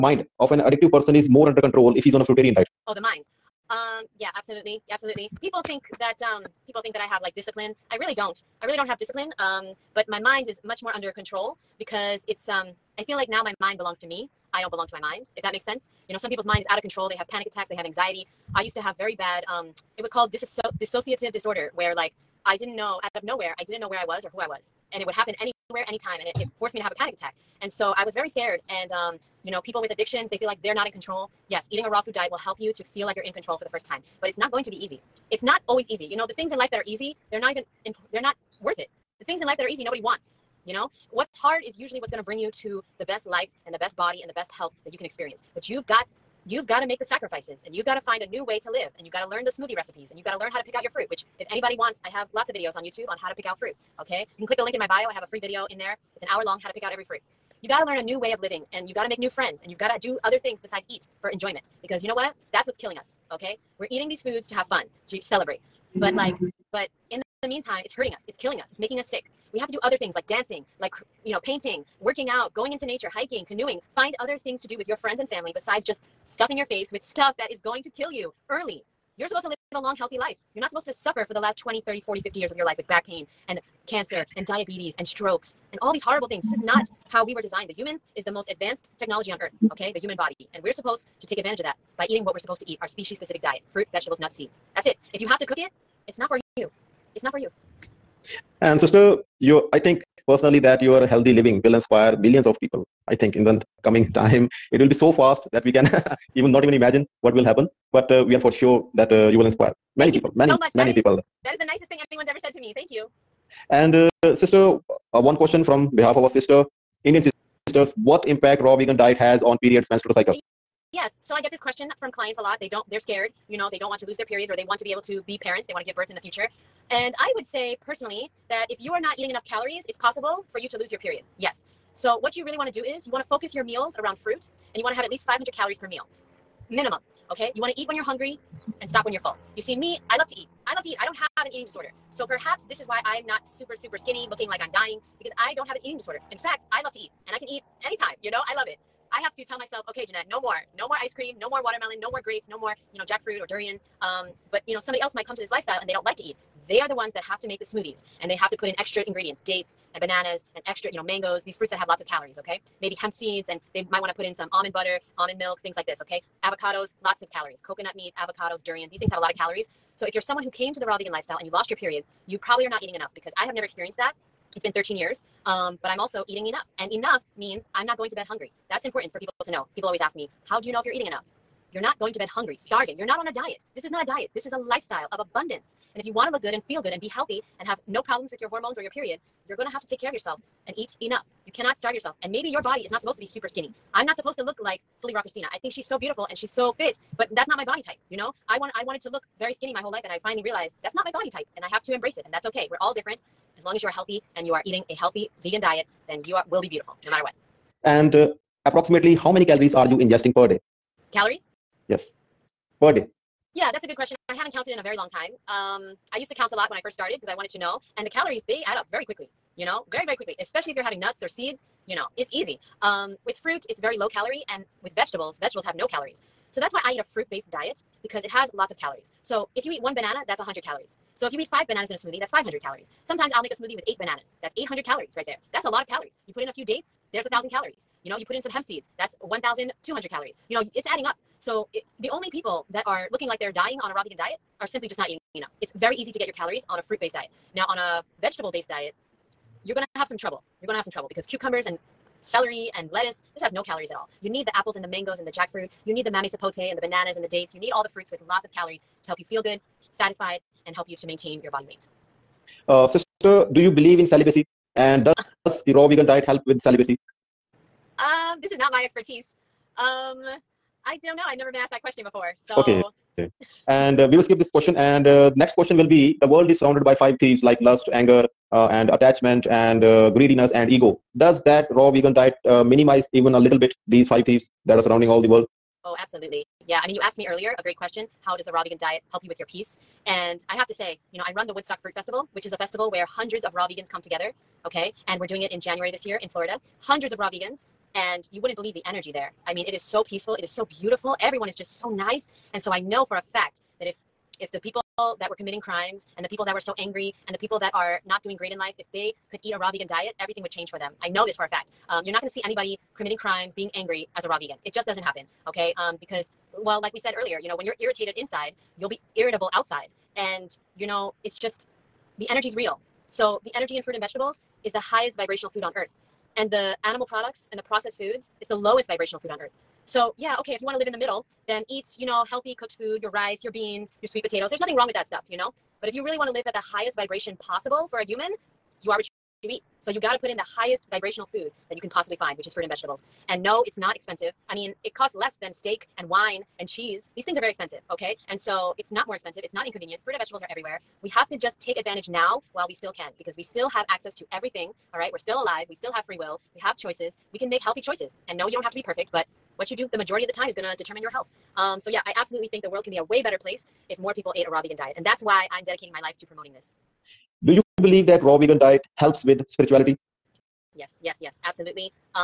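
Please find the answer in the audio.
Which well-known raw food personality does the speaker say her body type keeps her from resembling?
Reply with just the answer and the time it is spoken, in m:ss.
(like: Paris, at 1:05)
FullyRaw Kristina, at 3:15.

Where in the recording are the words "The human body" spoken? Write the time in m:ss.
1:29.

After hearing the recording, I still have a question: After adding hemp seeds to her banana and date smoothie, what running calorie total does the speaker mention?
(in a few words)
1,200 calories.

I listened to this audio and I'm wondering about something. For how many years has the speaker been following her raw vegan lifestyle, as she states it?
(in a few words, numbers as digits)
13 years.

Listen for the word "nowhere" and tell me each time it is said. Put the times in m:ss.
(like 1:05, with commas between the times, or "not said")
0:23.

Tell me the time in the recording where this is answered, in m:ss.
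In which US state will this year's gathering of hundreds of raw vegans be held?
4:56.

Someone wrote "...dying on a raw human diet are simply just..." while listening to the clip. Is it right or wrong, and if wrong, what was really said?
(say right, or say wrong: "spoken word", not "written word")
wrong: "vegan", not "human".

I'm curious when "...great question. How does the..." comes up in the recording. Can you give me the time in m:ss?
4:47.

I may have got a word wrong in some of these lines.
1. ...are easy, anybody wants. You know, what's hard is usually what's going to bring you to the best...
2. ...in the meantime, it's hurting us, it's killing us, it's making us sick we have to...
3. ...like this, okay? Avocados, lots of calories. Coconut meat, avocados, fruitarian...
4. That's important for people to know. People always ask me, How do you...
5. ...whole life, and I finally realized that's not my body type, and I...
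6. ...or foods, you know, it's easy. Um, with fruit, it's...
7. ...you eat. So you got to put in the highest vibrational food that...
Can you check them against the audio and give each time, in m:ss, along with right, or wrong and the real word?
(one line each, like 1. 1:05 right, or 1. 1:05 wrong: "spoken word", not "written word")
1. 0:39 wrong: "nobody", not "anybody"
2. 1:07 right
3. 2:45 wrong: "durian", not "fruitarian"
4. 2:58 right
5. 3:19 right
6. 3:41 wrong: "seeds", not "foods"
7. 5:39 right.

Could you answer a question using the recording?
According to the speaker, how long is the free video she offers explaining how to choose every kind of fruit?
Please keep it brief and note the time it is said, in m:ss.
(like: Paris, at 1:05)
an hour, at 0:56.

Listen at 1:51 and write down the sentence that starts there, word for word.
Is, that is the nicest thing anyone's ever said to me.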